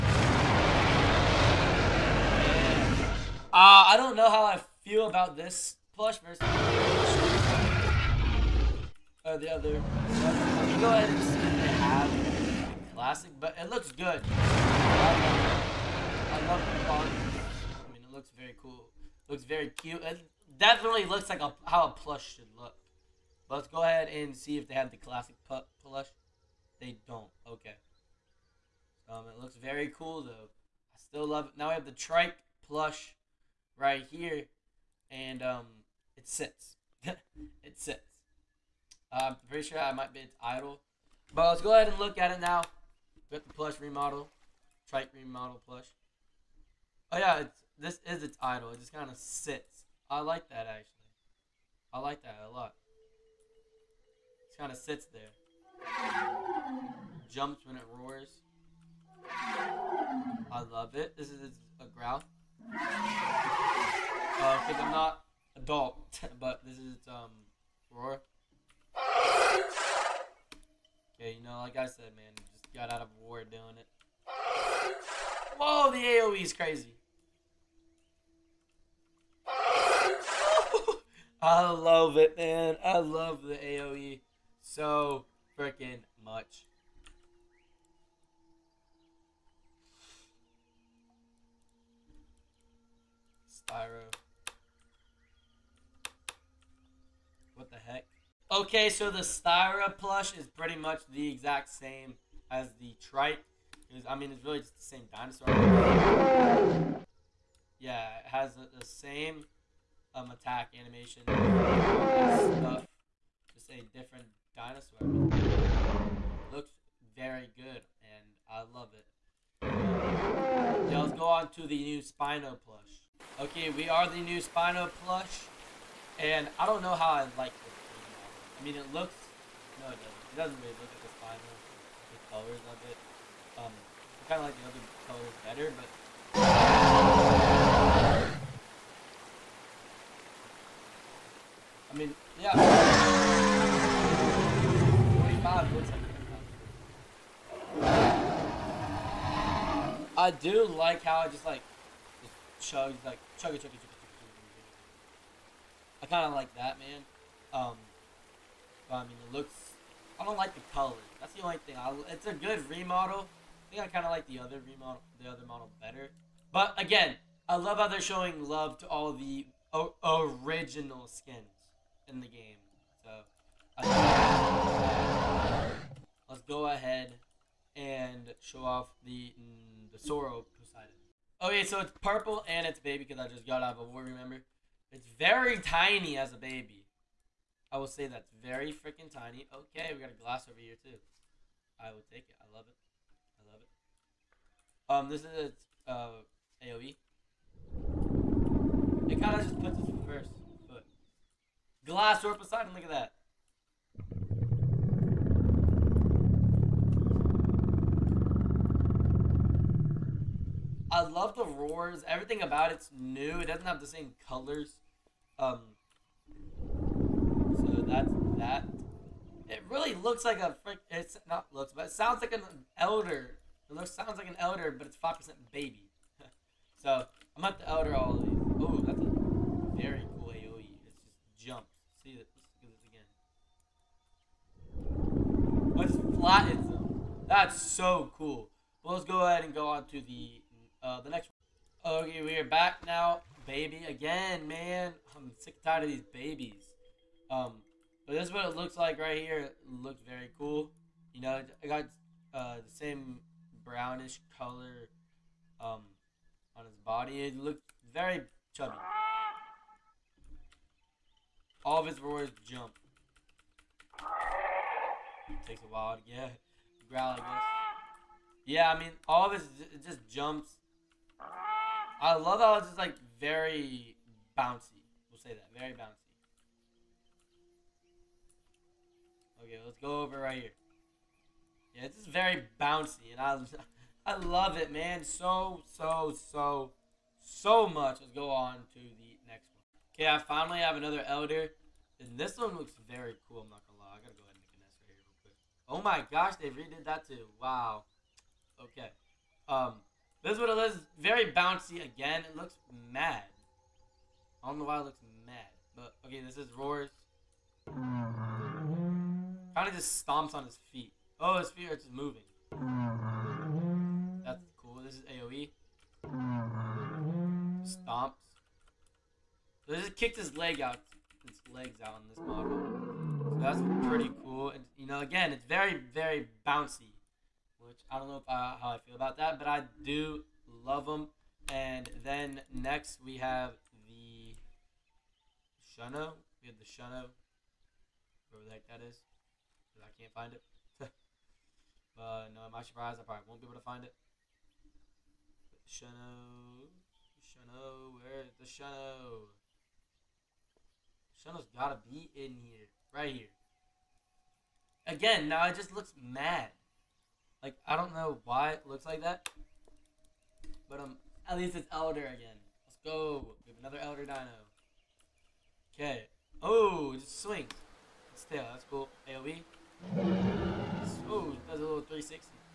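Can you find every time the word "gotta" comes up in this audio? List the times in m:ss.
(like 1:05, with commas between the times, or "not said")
4:54, 5:51.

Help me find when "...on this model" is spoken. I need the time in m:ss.
5:21.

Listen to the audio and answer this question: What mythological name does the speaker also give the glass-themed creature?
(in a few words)
Poseidon.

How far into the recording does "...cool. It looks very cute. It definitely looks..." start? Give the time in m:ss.
0:18.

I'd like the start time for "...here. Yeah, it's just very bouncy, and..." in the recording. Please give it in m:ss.
4:40.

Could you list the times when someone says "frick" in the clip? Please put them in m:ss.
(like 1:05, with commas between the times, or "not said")
3:40.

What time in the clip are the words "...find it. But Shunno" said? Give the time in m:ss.
5:43.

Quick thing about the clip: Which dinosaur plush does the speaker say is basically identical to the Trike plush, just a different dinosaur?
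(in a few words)
Styra.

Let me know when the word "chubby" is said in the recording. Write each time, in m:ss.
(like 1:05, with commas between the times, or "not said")
4:18.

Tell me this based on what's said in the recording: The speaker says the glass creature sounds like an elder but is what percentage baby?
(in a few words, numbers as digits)
5%.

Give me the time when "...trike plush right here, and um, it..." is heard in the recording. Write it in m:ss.
0:31.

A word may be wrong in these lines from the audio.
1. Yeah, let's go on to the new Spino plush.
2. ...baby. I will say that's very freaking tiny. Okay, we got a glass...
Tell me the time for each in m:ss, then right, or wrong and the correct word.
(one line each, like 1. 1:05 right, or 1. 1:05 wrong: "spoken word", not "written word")
1. 1:59 right
2. 3:06 right.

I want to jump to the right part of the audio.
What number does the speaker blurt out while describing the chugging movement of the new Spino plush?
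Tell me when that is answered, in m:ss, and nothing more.
2:25.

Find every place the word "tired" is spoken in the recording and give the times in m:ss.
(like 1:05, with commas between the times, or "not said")
4:05.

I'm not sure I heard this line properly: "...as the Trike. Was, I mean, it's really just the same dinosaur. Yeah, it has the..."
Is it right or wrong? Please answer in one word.
right.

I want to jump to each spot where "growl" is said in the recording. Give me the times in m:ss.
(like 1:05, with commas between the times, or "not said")
1:01, 4:26.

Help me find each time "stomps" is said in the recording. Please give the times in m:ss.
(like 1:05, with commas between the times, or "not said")
5:10, 5:17.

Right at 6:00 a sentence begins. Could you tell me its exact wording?
But, um, at least it's Elder again.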